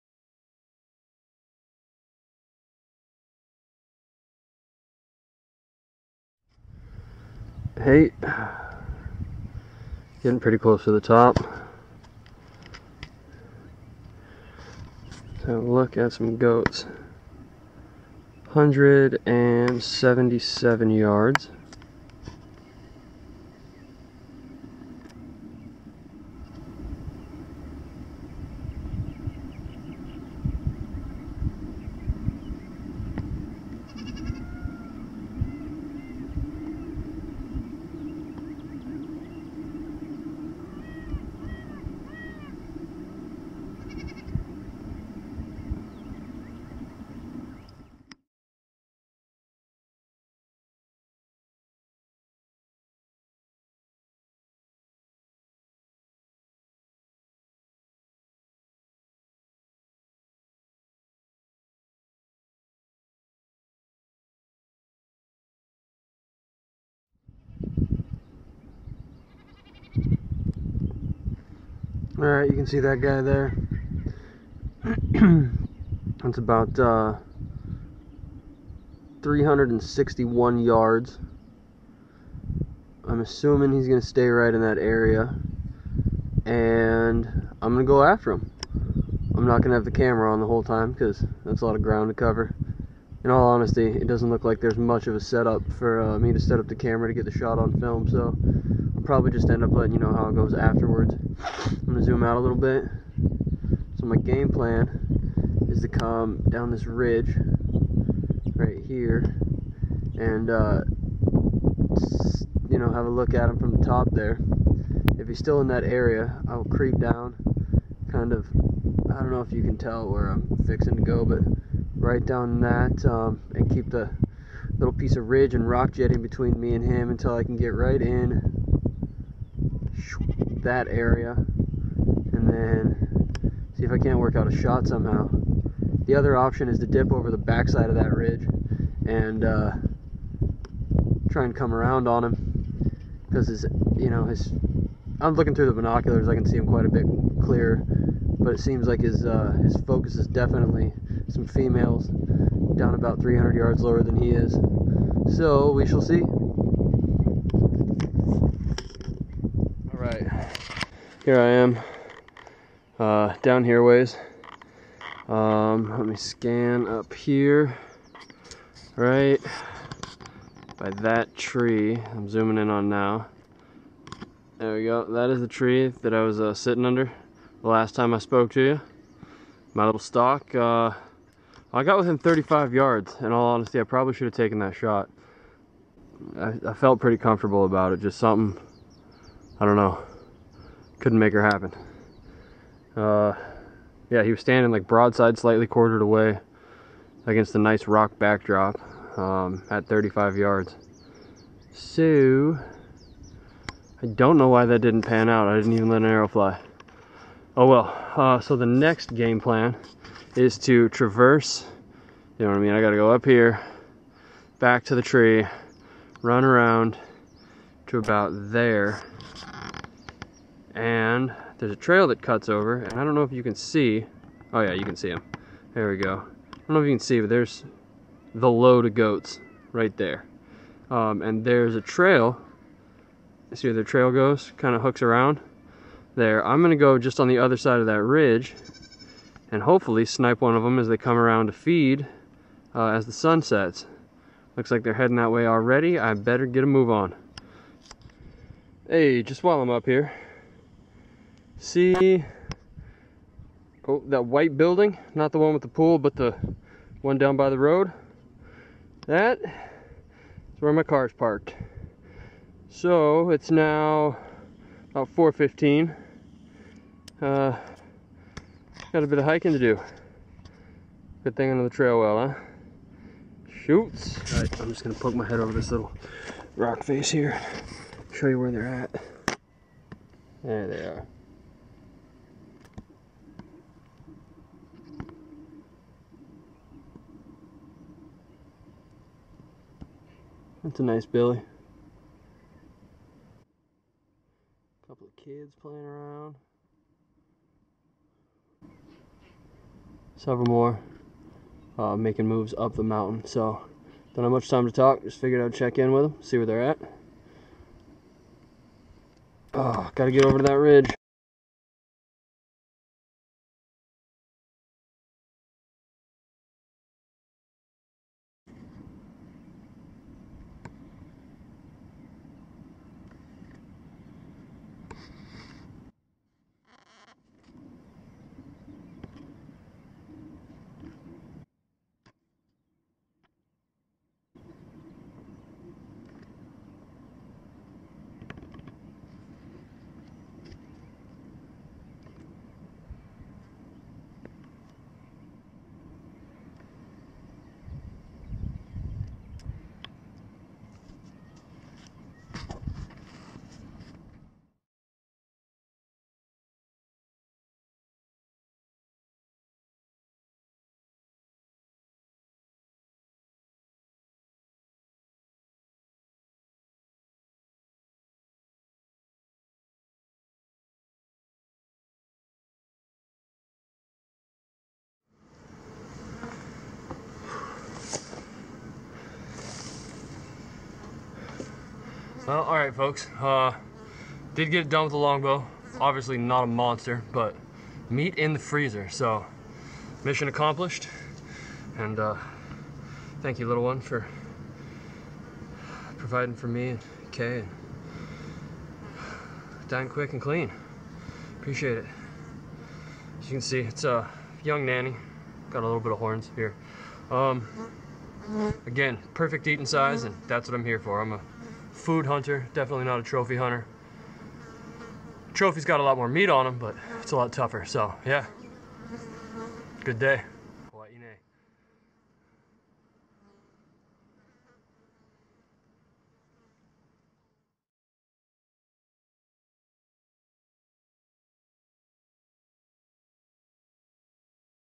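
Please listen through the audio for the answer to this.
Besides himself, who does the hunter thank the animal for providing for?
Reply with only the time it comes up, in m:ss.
6:37.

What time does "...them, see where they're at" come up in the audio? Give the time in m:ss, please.
5:06.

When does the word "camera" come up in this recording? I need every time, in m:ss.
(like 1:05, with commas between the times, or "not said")
1:29, 1:36.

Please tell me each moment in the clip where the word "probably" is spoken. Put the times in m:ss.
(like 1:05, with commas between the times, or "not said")
1:39, 3:03.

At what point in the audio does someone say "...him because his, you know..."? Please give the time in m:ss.
2:22.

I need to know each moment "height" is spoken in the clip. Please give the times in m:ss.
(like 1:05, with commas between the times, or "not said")
0:07.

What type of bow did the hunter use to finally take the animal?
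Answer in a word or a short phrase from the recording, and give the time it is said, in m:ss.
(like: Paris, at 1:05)
Longbow, at 6:24.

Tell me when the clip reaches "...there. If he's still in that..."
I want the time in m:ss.
1:54.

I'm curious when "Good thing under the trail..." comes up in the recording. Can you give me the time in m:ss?
4:31.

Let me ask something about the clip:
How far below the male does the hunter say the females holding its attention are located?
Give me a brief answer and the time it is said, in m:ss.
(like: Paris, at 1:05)
300 yards, at 2:33.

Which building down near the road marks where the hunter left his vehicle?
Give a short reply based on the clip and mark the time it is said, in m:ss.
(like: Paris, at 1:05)
White building, at 4:14.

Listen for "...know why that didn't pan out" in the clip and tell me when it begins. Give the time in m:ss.
3:24.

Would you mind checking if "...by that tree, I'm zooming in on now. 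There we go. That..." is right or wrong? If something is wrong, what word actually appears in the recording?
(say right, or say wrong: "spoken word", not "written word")
right.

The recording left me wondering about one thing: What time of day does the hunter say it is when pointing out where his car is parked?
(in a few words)
4:15.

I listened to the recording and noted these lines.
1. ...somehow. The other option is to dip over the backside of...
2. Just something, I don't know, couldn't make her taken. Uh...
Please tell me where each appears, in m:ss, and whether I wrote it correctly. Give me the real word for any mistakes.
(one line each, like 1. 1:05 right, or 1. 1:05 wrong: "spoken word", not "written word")
1. 2:14 right
2. 3:08 wrong: "happen", not "taken".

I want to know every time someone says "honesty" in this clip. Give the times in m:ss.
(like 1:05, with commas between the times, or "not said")
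1:33, 3:03.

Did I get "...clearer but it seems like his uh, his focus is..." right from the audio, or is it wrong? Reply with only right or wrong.
right.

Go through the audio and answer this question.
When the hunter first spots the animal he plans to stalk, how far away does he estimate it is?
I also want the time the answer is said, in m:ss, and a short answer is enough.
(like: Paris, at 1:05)
361 yards, at 1:19.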